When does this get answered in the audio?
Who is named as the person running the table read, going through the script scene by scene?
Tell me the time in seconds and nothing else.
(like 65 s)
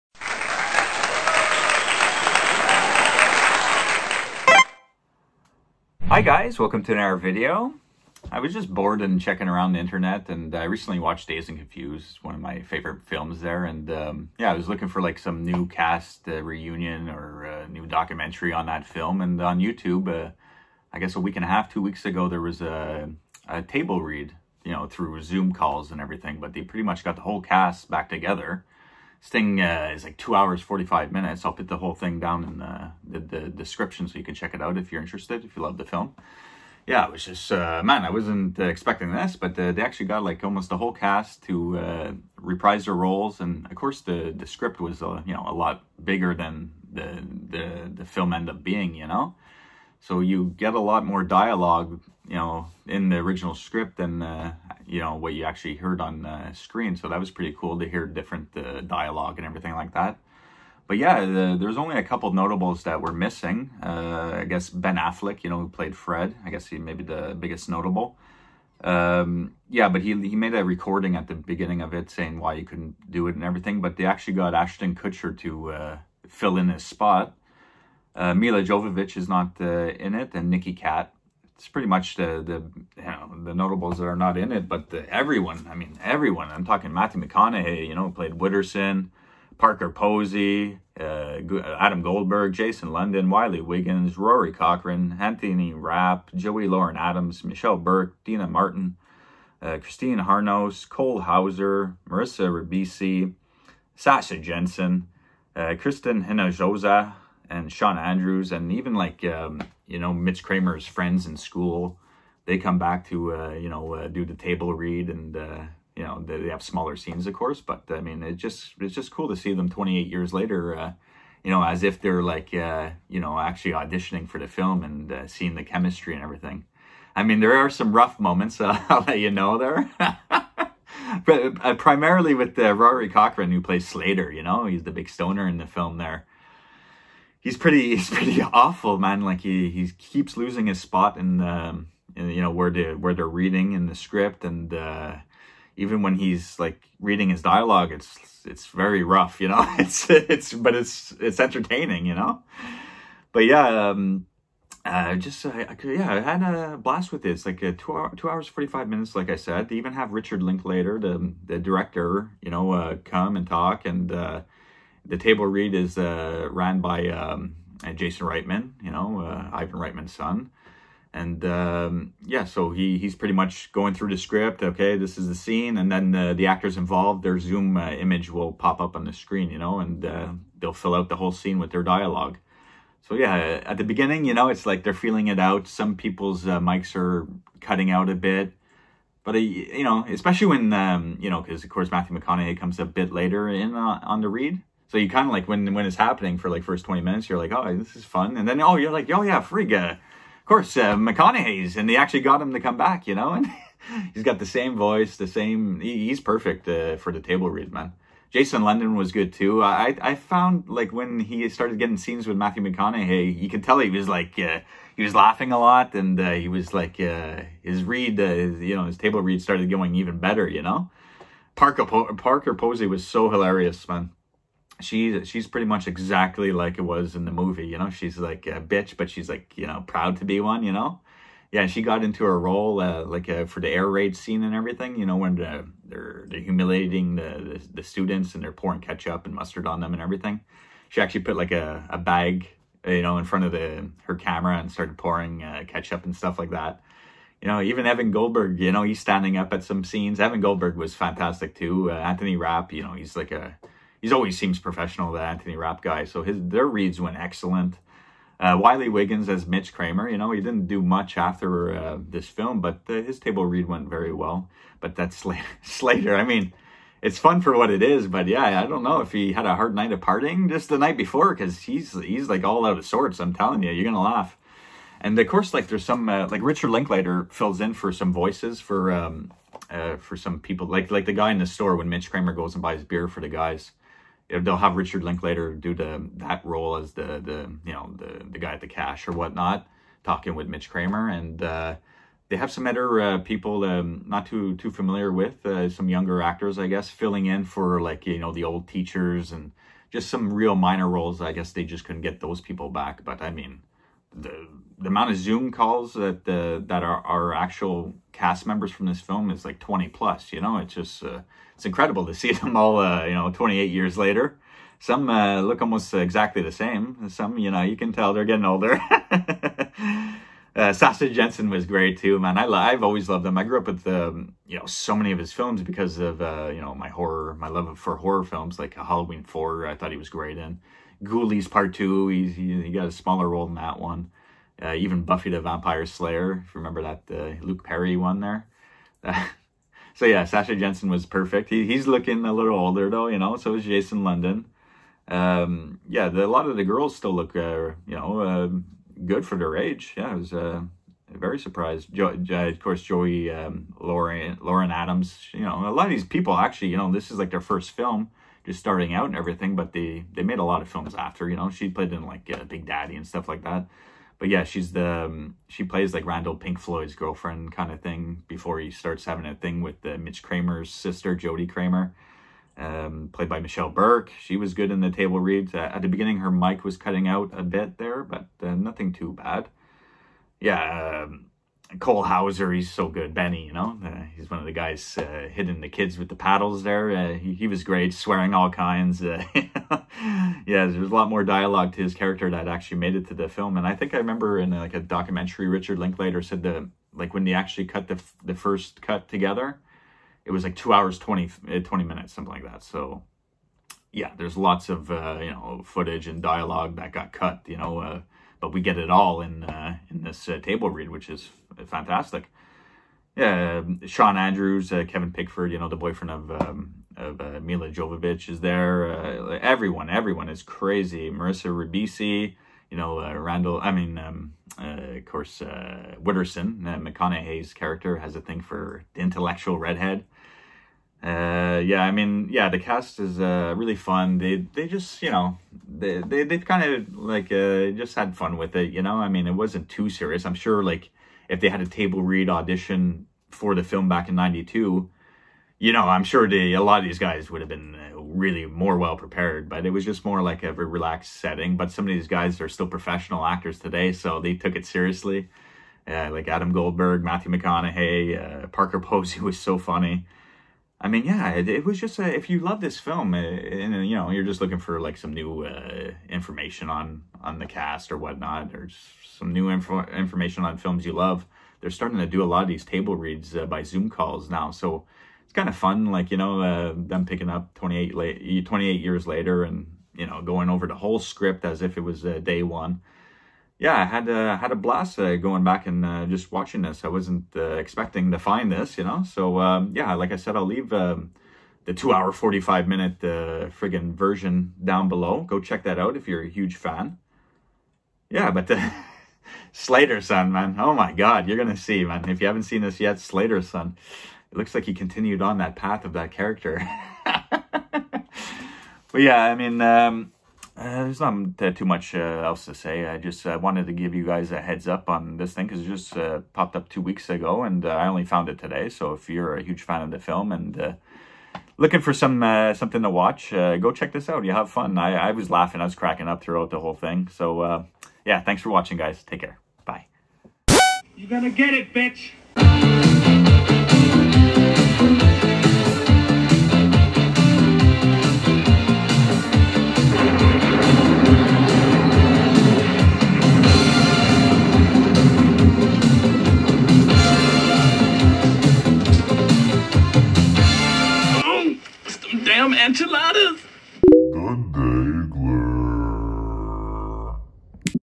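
167 s.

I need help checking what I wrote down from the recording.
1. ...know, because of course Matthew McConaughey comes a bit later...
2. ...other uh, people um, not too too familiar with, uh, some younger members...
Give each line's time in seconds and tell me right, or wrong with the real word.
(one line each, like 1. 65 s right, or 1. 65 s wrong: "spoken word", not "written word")
1. 191 s right
2. 292 s wrong: "actors", not "members".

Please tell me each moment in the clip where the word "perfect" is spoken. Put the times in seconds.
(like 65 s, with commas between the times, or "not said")
206 s, 341 s.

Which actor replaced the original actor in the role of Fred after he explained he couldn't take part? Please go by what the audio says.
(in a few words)
Ashton Kutcher.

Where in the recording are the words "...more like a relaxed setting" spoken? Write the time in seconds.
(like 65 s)
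450 s.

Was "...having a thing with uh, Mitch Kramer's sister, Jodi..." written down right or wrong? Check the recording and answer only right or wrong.
right.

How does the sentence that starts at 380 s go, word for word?
Yeah, um, Cole Hauser, he's so good.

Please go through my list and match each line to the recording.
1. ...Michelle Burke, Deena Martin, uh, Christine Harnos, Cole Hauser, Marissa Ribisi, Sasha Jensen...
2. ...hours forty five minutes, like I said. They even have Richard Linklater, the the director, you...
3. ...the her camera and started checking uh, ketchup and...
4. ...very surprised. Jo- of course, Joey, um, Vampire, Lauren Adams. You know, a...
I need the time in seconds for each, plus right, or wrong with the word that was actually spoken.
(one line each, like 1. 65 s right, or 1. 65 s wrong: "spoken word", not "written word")
1. 97 s right
2. 158 s right
3. 243 s wrong: "pouring", not "checking"
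4. 351 s wrong: "Lauren", not "Vampire".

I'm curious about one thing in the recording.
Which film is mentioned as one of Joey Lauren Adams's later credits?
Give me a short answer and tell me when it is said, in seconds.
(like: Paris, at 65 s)
Big Daddy, at 362 s.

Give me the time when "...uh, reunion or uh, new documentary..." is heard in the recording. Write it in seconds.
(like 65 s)
16 s.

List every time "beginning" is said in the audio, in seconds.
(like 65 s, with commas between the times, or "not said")
71 s, 183 s, 375 s.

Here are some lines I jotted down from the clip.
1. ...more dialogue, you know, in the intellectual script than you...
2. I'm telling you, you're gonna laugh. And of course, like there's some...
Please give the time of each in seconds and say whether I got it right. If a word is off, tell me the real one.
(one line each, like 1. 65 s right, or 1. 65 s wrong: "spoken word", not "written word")
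1. 51 s wrong: "original", not "intellectual"
2. 273 s right.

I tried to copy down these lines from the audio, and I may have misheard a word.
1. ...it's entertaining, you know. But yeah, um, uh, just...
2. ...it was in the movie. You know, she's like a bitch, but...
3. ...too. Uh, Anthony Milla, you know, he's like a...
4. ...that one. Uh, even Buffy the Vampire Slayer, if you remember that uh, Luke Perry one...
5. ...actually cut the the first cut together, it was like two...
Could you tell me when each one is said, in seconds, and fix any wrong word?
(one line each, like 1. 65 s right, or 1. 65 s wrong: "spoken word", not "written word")
1. 151 s right
2. 226 s right
3. 251 s wrong: "Rapp", not "Milla"
4. 333 s right
5. 397 s right.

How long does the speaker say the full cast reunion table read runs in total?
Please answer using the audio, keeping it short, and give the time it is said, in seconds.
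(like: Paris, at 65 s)
2 hours 45 minutes, at 30 s.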